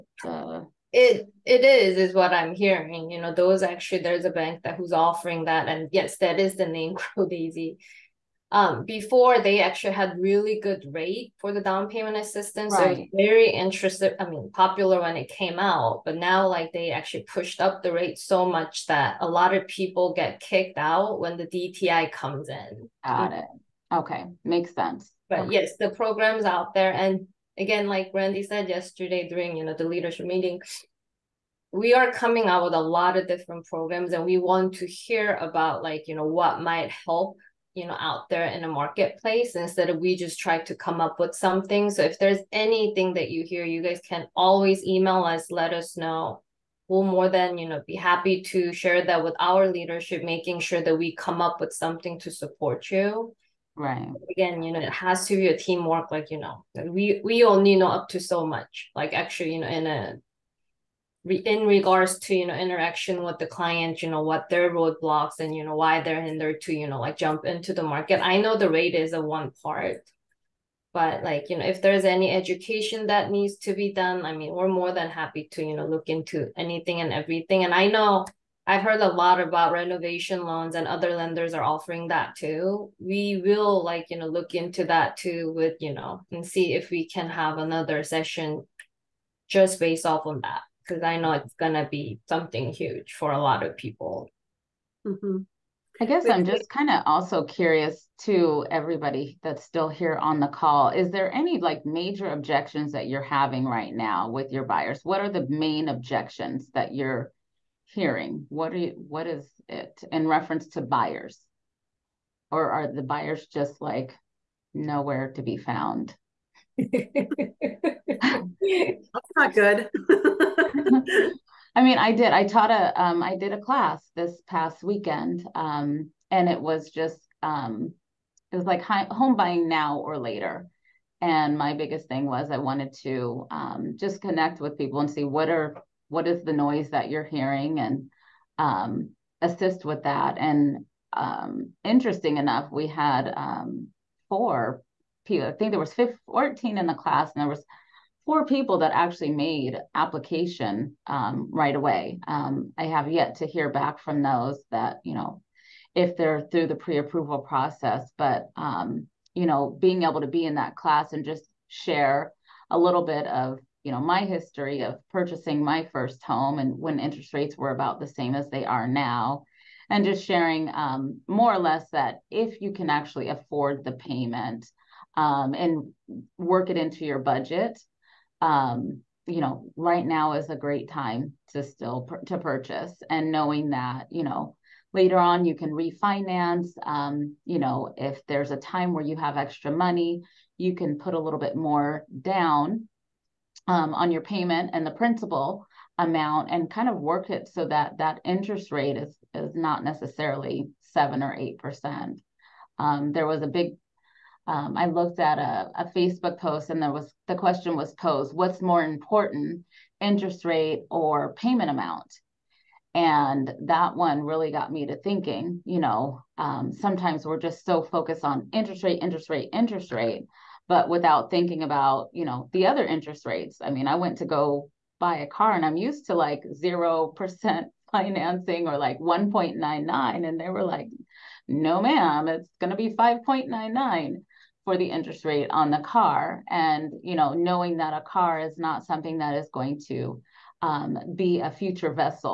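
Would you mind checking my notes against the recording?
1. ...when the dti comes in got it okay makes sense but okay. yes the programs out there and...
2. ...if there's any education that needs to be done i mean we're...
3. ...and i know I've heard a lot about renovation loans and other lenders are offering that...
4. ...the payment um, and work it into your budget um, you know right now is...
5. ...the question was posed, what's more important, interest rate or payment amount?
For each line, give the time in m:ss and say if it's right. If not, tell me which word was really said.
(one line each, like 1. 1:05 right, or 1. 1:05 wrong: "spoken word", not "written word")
1. 0:21 right
2. 1:11 right
3. 1:17 right
4. 2:53 right
5. 3:27 right.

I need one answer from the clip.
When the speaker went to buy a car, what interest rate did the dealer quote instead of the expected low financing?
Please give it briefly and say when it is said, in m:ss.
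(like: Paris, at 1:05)
5.99, at 3:52.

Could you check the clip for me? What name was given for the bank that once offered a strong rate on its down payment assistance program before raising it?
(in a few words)
Crow Daisy.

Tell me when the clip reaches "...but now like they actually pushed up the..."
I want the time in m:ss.
0:16.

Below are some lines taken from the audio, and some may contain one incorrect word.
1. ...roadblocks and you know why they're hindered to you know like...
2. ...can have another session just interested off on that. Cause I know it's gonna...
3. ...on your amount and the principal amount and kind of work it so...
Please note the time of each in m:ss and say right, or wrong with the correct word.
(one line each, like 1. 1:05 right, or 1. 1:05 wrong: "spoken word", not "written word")
1. 1:04 right
2. 1:27 wrong: "based", not "interested"
3. 3:13 wrong: "payment", not "amount".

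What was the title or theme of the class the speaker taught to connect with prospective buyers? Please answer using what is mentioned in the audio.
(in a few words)
Home buying now or later.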